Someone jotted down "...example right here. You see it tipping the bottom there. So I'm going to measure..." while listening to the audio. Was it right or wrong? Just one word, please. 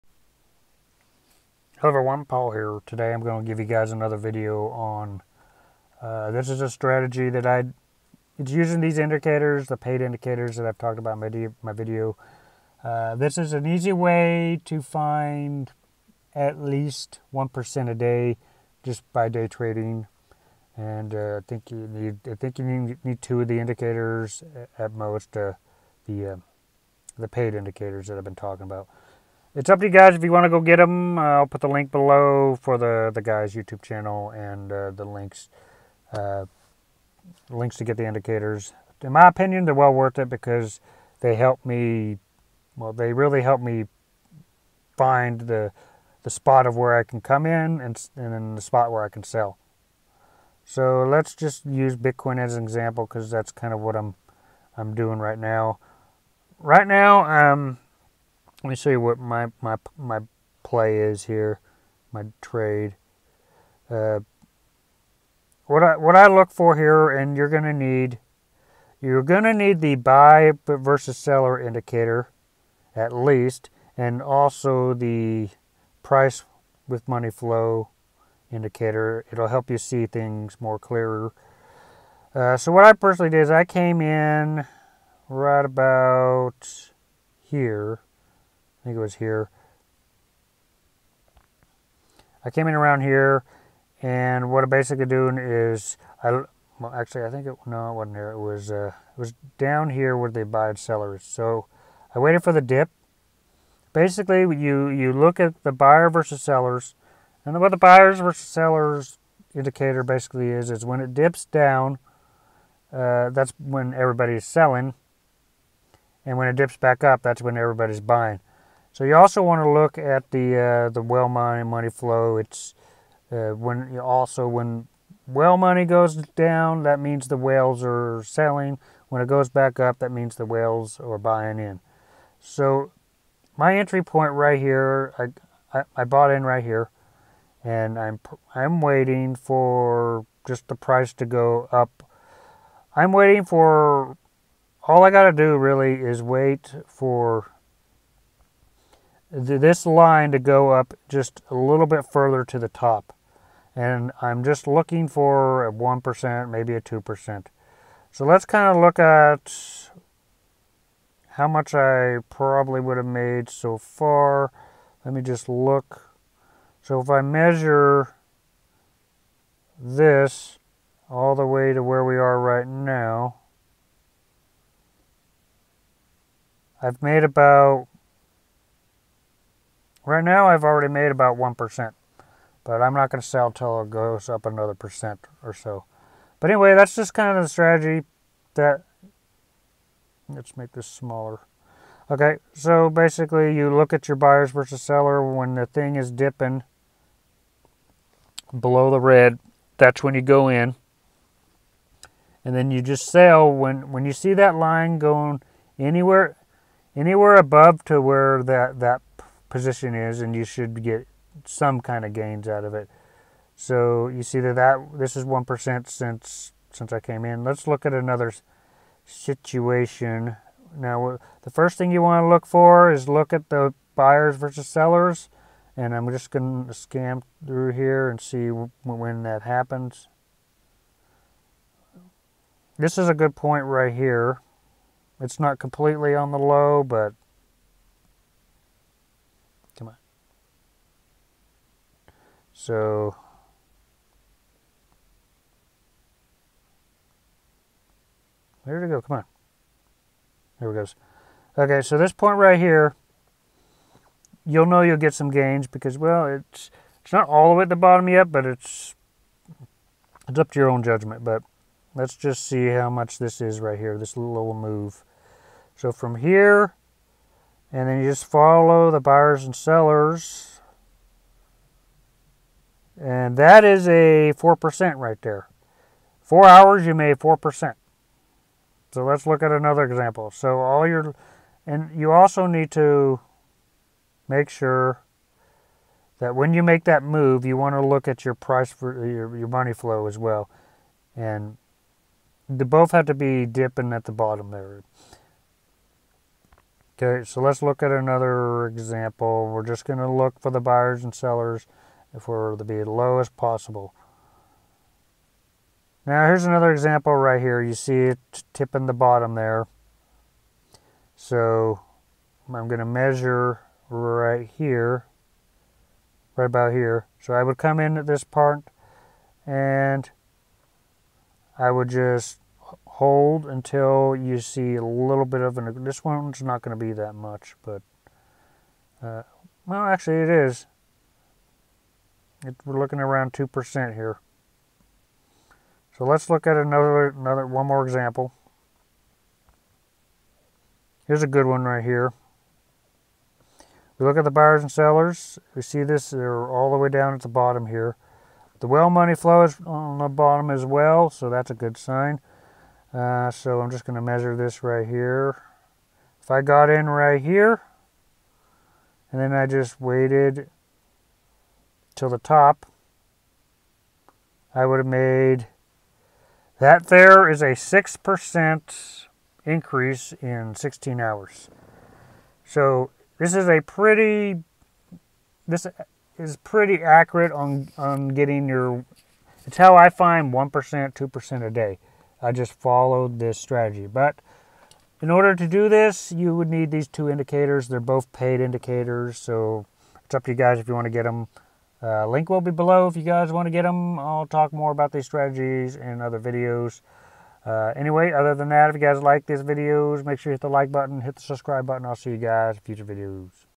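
right.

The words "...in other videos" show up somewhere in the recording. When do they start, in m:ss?
6:35.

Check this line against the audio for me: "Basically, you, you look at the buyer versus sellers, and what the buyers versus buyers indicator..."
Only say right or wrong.
wrong.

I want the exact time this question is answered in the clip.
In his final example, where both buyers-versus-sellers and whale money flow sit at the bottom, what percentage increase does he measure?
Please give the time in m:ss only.
6:07.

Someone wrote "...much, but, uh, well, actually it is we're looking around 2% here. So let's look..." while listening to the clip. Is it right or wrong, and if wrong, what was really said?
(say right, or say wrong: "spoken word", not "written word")
right.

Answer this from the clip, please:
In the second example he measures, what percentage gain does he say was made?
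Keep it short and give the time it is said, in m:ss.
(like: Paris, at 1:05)
4%, at 4:33.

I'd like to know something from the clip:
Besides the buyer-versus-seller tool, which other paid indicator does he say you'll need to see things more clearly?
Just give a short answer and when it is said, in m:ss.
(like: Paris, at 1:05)
price with money flow, at 1:16.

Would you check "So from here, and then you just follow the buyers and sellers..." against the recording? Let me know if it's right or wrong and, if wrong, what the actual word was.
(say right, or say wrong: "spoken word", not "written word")
right.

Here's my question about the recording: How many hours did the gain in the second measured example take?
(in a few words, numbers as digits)
4.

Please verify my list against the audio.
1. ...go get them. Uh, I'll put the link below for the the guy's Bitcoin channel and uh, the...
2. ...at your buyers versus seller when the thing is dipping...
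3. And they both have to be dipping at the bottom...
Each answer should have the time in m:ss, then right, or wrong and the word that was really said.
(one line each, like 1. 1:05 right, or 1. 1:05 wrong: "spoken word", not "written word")
1. 0:30 wrong: "YouTube", not "Bitcoin"
2. 3:13 right
3. 4:51 right.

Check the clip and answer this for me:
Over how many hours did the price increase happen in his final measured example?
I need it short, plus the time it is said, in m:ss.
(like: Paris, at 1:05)
16, at 6:10.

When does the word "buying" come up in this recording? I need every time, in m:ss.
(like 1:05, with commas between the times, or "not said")
1:58, 2:11.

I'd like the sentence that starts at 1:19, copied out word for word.
It'll help you see things more clearer.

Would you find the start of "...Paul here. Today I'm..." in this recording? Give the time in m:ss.
0:02.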